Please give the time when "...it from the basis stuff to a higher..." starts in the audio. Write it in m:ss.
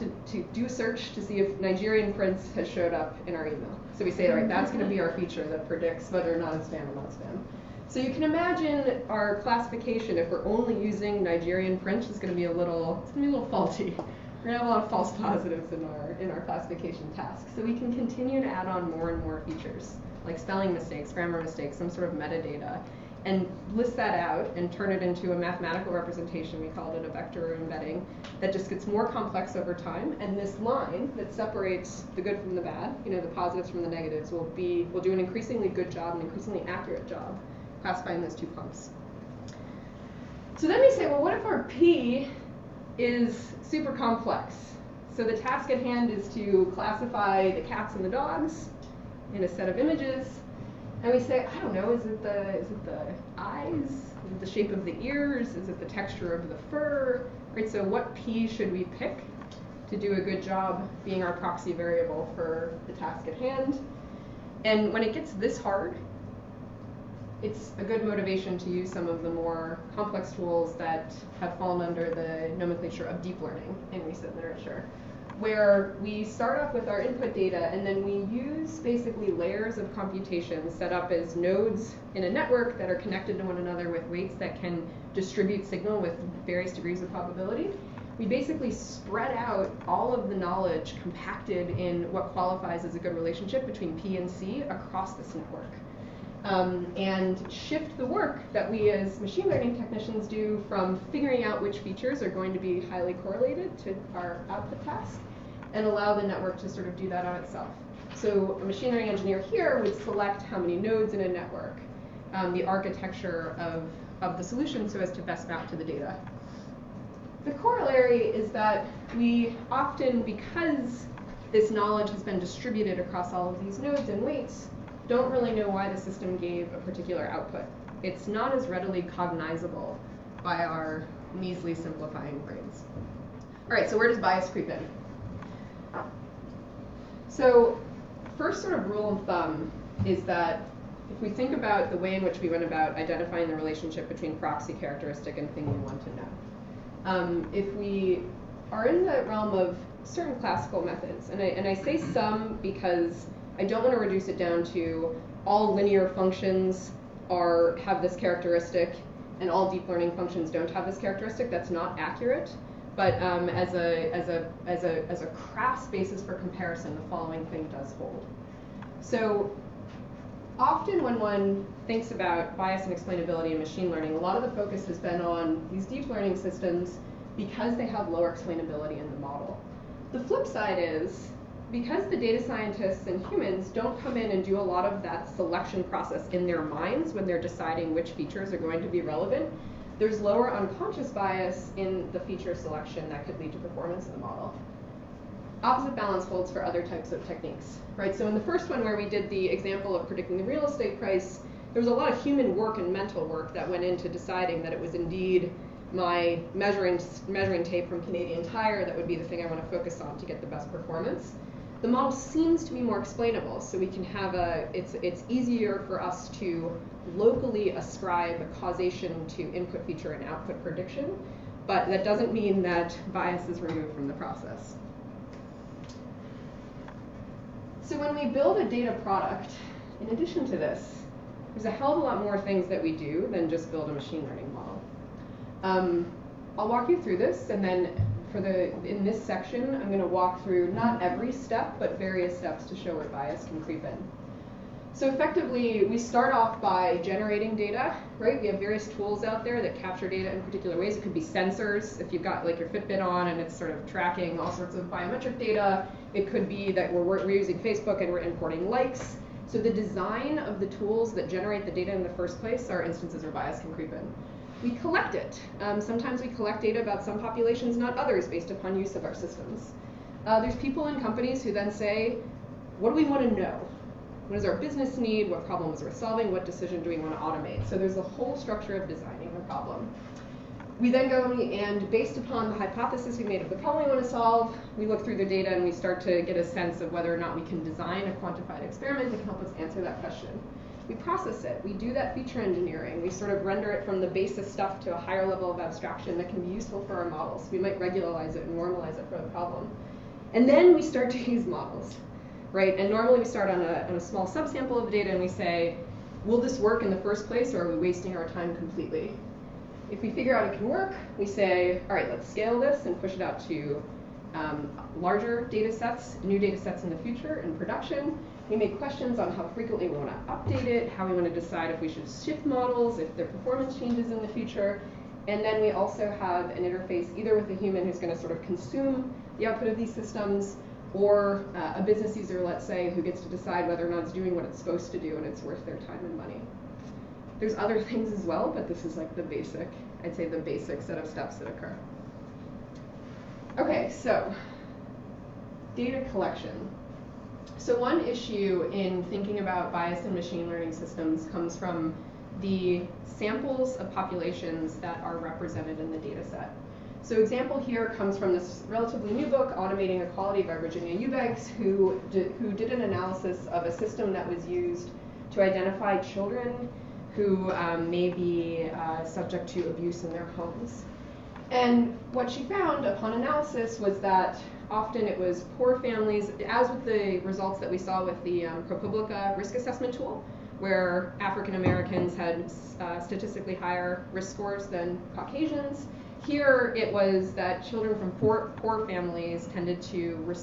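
4:53.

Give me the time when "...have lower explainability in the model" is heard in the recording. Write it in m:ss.
2:57.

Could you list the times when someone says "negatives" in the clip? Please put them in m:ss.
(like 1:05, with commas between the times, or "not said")
0:33.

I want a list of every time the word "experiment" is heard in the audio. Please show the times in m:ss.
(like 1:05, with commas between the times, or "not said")
4:48.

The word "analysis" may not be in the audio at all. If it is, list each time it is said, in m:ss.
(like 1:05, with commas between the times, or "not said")
6:02, 6:13.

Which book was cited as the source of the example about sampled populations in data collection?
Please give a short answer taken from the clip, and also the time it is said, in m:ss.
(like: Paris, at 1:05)
Automating Equality, at 5:59.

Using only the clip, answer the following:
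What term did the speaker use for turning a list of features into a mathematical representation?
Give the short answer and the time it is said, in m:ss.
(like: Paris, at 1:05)
vector embedding, at 0:27.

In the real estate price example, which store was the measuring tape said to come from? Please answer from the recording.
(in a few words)
Canadian Tire.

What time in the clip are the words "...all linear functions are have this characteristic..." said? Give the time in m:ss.
2:35.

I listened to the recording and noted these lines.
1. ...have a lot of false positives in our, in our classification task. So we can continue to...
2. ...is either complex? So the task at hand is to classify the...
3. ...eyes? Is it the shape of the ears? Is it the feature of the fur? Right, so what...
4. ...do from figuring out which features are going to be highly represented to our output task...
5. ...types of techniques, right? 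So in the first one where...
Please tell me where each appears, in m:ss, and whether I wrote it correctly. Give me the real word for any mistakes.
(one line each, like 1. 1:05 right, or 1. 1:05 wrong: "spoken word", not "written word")
1. 0:14 right
2. 0:42 wrong: "super", not "either"
3. 0:53 wrong: "texture", not "feature"
4. 1:40 wrong: "correlated", not "represented"
5. 3:16 right.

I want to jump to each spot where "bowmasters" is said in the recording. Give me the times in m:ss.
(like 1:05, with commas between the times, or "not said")
not said.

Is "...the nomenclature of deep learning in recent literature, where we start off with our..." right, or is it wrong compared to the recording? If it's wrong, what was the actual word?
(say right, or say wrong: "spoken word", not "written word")
right.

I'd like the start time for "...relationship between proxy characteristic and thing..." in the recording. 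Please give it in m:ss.
2:23.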